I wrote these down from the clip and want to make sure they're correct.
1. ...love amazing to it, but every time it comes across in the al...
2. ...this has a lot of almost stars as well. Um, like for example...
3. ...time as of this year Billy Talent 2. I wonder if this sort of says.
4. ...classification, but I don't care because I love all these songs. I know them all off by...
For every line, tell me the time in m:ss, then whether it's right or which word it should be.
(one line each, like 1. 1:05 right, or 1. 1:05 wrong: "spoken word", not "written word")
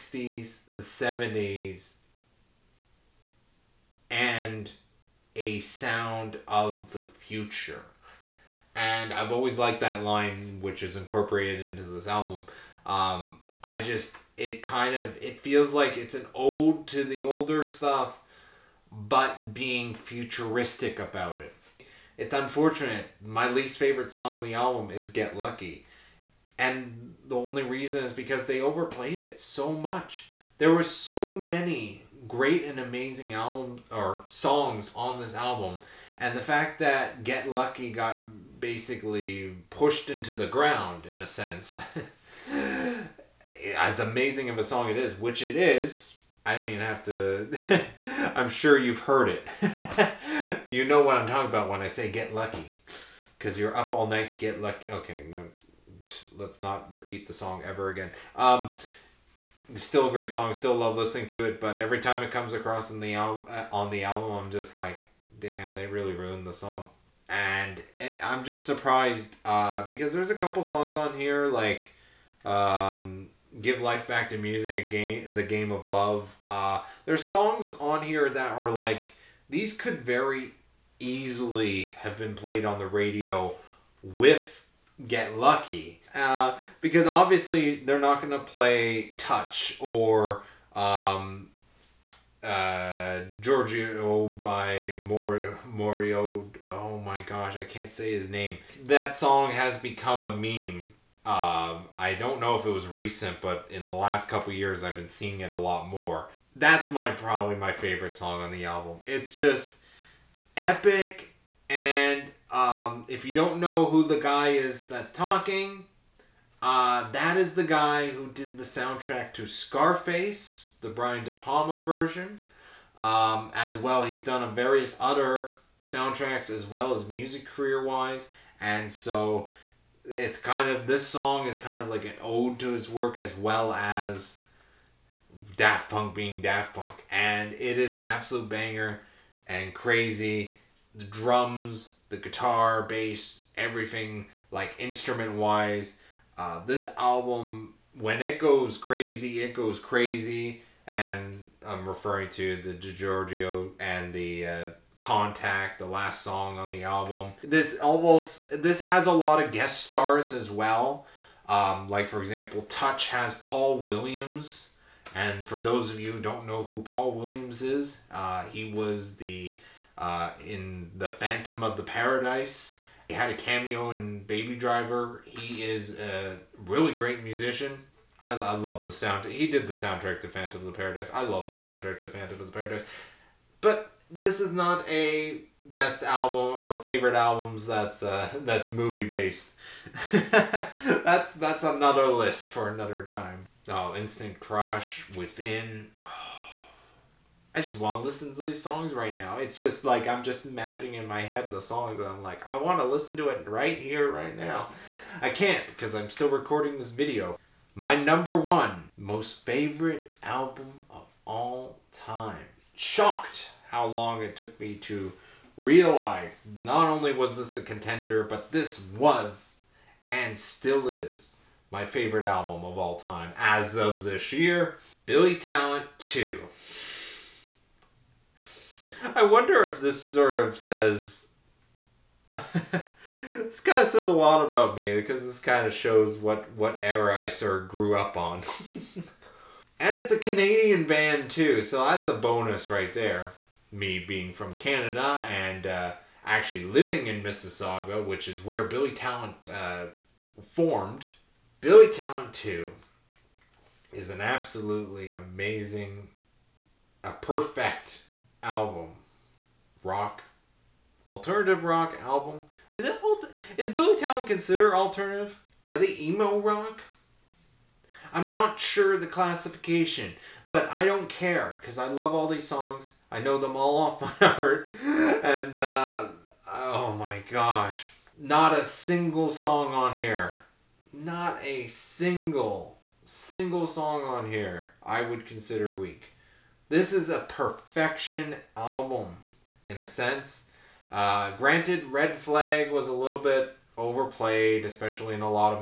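1. 1:00 wrong: "listening", not "amazing"
2. 2:38 wrong: "guest", not "almost"
3. 3:43 right
4. 4:29 right.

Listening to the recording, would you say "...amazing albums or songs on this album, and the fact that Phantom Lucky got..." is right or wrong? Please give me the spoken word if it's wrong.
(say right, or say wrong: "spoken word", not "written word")
wrong: "Get", not "Phantom".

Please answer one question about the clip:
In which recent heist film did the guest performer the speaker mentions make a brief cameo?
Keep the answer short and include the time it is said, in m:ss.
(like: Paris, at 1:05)
Baby Driver, at 2:54.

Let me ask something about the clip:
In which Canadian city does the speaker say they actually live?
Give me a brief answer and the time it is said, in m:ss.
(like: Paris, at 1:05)
Mississauga, at 4:07.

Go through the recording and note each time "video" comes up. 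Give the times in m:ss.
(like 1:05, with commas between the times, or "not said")
3:26.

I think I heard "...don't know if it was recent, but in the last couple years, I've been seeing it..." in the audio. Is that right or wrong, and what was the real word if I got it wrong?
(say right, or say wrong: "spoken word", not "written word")
right.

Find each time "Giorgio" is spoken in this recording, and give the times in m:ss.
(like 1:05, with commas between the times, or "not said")
1:33, 2:32.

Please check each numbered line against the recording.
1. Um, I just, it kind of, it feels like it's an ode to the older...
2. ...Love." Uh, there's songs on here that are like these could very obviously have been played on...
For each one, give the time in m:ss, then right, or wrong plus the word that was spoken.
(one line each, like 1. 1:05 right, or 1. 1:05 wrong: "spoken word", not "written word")
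1. 0:12 right
2. 1:15 wrong: "easily", not "obviously".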